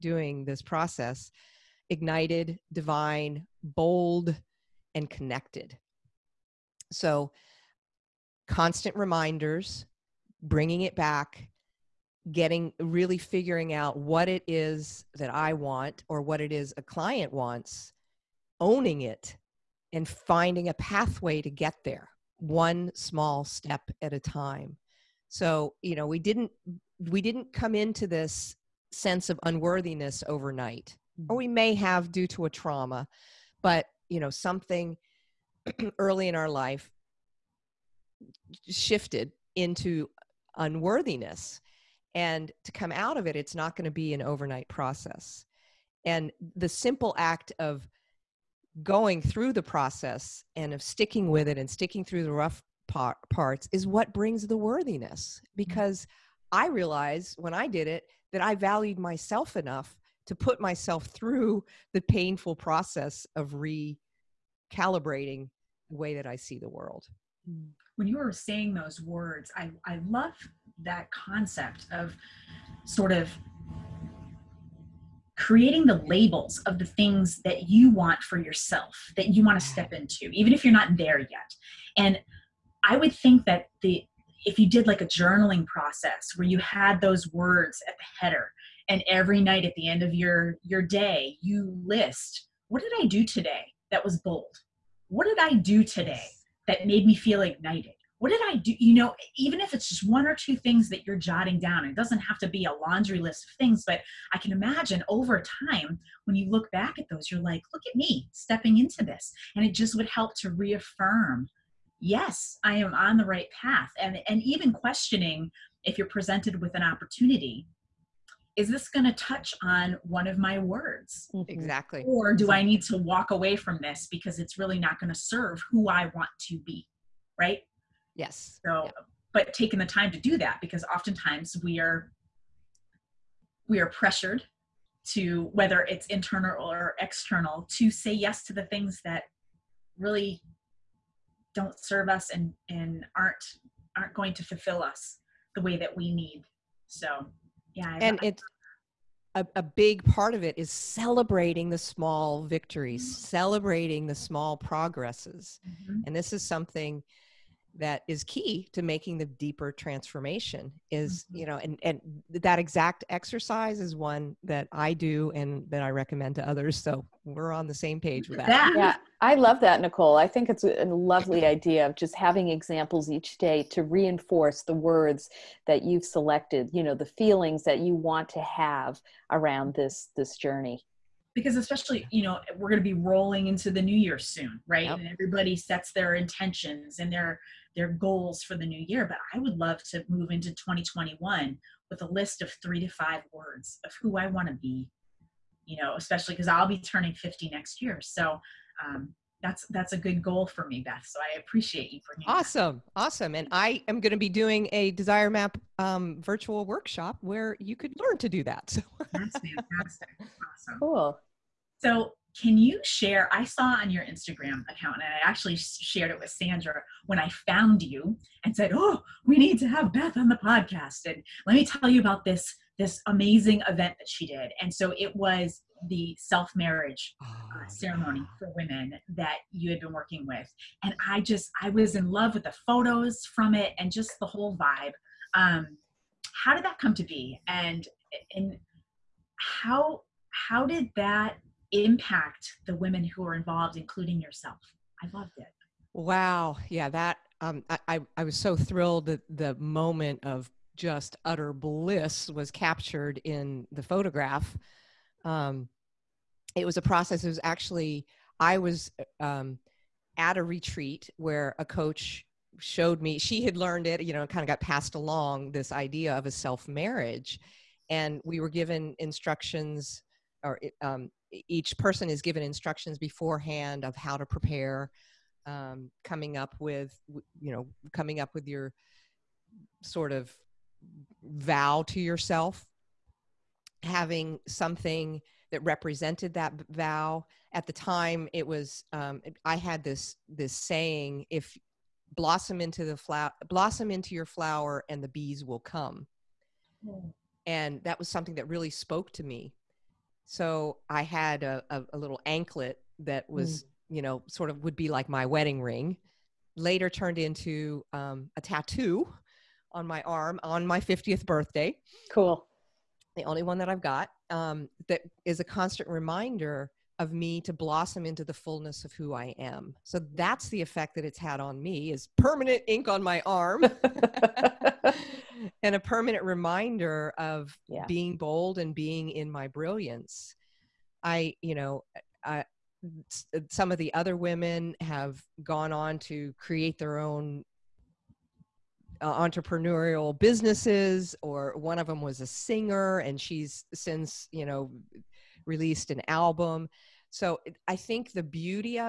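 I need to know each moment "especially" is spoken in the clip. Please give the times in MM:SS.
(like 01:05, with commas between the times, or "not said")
03:01, 03:15.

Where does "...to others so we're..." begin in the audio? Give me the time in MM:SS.
02:46.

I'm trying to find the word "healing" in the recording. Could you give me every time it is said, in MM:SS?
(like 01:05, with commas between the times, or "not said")
not said.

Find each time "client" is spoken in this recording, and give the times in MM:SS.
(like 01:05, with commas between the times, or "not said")
00:16.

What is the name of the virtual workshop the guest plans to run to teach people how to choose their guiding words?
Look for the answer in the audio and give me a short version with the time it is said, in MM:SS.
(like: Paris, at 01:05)
Desire Map, at 03:24.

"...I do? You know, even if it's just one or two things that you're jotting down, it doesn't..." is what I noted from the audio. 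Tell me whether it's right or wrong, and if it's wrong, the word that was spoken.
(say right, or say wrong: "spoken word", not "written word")
right.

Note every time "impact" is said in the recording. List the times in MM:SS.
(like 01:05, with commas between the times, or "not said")
04:01.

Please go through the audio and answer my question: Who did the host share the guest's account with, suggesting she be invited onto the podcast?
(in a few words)
Sandra.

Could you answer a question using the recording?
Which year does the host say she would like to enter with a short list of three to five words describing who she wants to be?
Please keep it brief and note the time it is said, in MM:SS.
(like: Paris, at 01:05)
2021, at 03:10.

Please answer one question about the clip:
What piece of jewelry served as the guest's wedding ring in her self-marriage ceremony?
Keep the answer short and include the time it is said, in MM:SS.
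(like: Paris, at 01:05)
anklet, at 05:02.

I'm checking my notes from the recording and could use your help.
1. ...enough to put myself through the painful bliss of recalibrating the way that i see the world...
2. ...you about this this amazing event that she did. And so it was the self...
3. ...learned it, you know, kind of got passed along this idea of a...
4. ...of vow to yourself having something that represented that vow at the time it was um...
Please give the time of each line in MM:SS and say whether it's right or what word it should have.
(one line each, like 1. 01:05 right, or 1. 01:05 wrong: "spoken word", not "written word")
1. 00:59 wrong: "process", not "bliss"
2. 03:41 right
3. 04:23 right
4. 04:40 right.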